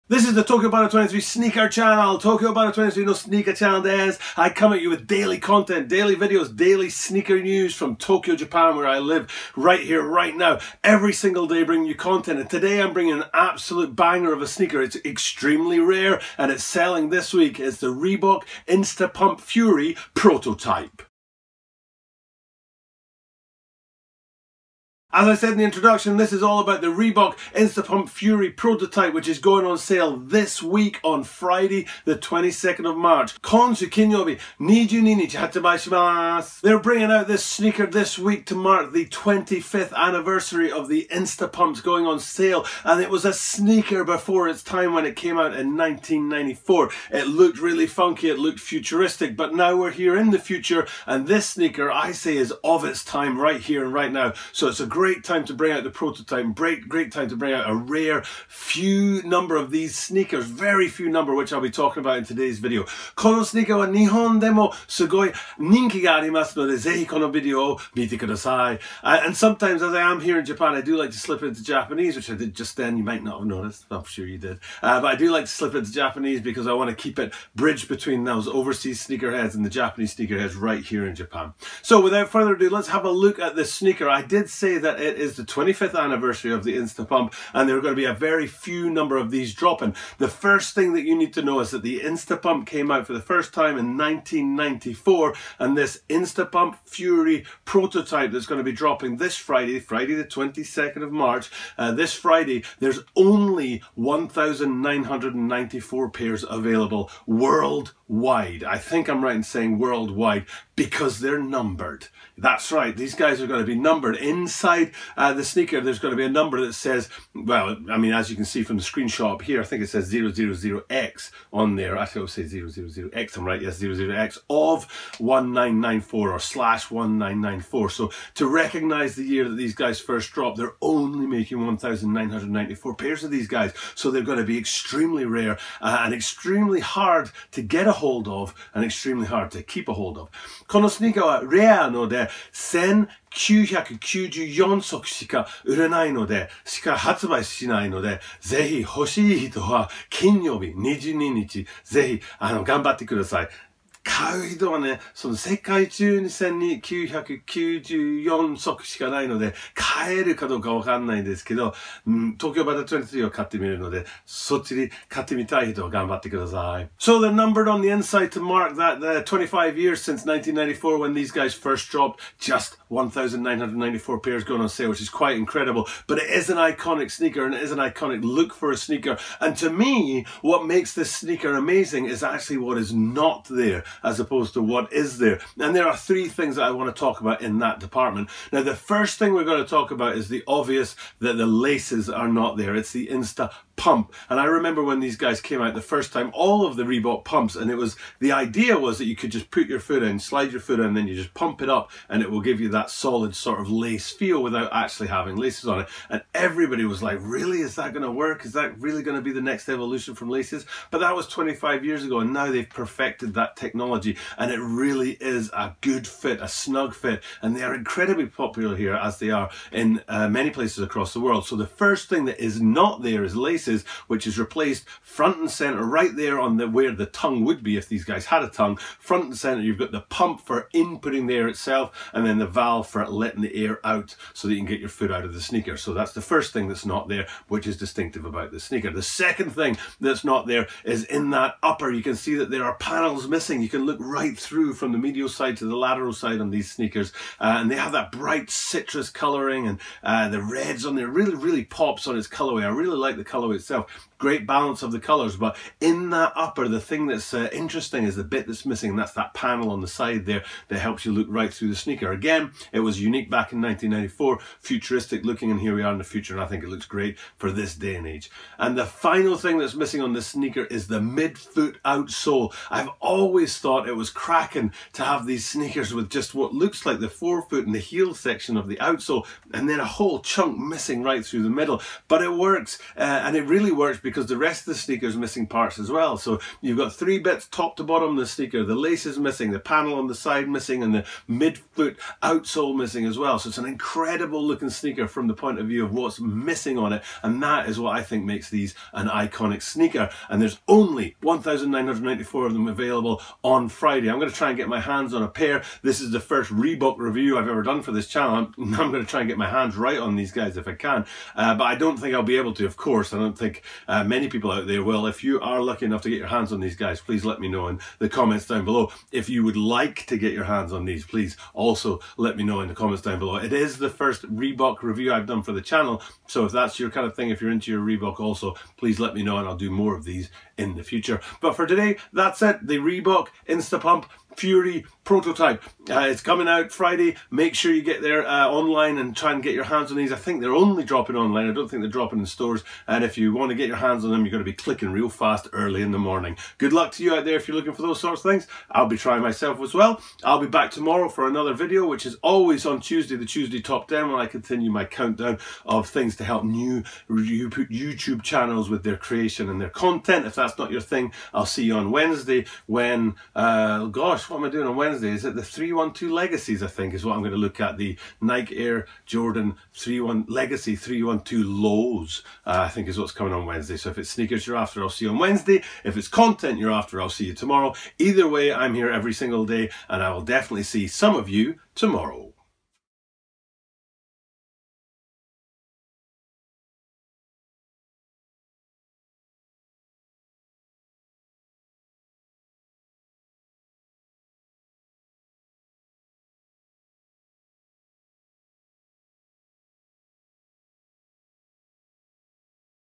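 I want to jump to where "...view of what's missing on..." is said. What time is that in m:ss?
4:55.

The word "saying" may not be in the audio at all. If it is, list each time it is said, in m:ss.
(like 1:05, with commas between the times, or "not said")
1:49.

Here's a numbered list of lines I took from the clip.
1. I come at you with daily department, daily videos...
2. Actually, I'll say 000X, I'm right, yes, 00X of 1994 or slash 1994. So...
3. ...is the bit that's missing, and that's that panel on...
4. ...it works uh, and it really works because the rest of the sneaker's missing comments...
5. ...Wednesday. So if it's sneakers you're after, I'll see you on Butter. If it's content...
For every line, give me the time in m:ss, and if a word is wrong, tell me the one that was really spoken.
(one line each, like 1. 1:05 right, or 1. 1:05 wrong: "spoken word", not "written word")
1. 0:04 wrong: "content", not "department"
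2. 2:01 right
3. 4:18 right
4. 4:42 wrong: "parts", not "comments"
5. 6:13 wrong: "Wednesday", not "Butter".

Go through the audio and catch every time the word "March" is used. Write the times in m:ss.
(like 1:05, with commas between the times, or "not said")
0:32, 1:41.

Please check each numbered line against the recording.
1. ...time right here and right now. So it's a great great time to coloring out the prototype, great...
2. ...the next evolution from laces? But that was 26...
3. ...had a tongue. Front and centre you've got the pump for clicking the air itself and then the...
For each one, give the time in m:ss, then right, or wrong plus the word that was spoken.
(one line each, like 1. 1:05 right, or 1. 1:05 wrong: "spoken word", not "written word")
1. 0:53 wrong: "bring", not "coloring"
2. 3:29 wrong: "25", not "26"
3. 3:48 wrong: "inputting", not "clicking".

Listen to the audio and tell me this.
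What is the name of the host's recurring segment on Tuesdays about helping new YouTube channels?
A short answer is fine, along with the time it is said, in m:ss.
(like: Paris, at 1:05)
Tuesday Top 10, at 5:53.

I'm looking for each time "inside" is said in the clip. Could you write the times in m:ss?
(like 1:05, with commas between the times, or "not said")
1:54, 2:47.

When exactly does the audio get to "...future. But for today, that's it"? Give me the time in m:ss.
5:30.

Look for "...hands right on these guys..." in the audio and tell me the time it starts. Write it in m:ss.
5:09.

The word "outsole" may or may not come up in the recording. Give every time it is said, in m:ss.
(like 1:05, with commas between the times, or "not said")
4:31, 4:38, 4:52.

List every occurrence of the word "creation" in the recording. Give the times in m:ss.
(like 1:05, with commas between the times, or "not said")
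5:58.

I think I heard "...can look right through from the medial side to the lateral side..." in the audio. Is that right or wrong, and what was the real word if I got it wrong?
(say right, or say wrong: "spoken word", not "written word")
right.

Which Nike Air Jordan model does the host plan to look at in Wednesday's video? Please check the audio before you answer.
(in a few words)
Air Jordan 31 Legacy 312 Low.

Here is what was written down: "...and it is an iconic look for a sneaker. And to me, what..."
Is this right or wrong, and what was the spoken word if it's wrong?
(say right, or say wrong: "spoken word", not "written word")
right.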